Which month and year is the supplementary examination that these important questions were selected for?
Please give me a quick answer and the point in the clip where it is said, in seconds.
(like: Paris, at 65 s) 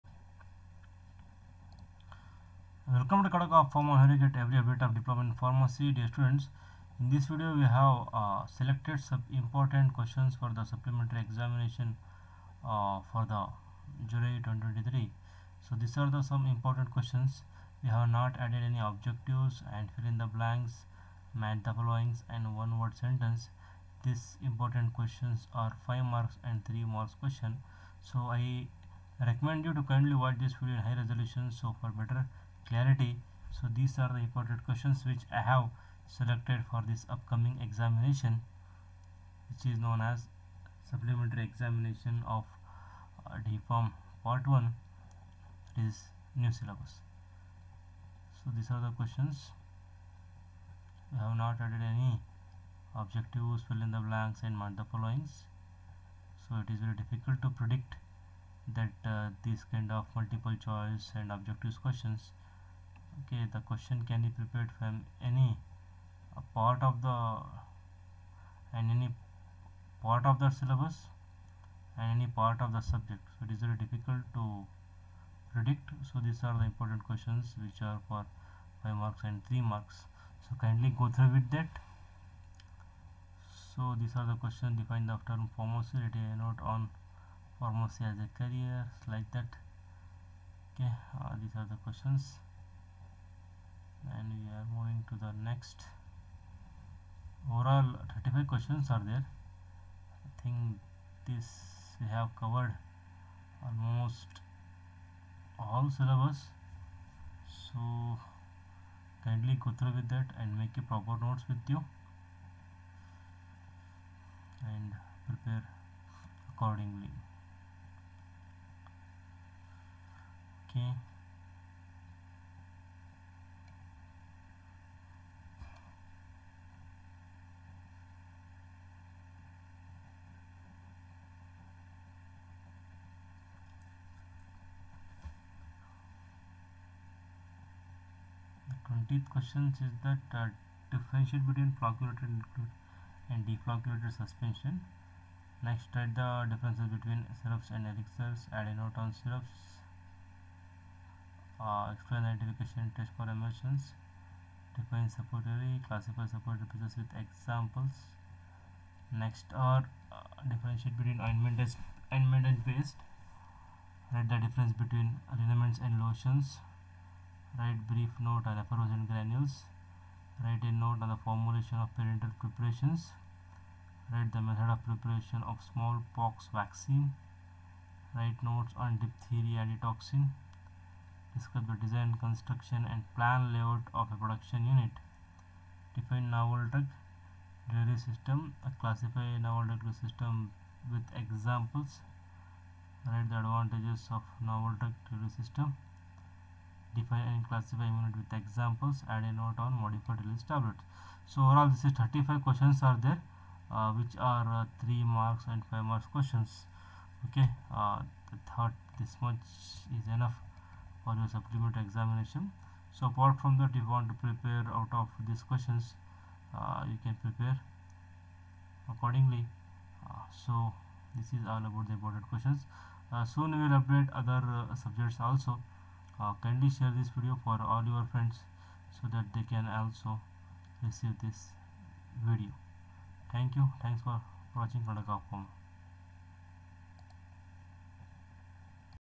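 July 2023, at 14 s.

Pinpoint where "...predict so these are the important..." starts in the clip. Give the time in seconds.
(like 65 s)
75 s.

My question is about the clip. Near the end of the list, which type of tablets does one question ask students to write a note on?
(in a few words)
Modified release tablets.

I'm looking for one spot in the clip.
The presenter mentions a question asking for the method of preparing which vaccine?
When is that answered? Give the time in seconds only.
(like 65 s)
175 s.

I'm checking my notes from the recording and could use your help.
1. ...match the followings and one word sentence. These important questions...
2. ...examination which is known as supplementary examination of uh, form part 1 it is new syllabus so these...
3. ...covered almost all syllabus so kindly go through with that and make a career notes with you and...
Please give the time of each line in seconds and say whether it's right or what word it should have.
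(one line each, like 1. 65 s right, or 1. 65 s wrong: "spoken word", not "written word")
1. 21 s right
2. 37 s right
3. 102 s wrong: "proper", not "career".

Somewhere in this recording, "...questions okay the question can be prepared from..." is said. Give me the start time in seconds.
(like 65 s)
61 s.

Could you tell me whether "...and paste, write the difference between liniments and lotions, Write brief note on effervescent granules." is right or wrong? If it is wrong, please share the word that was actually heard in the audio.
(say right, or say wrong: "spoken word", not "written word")
right.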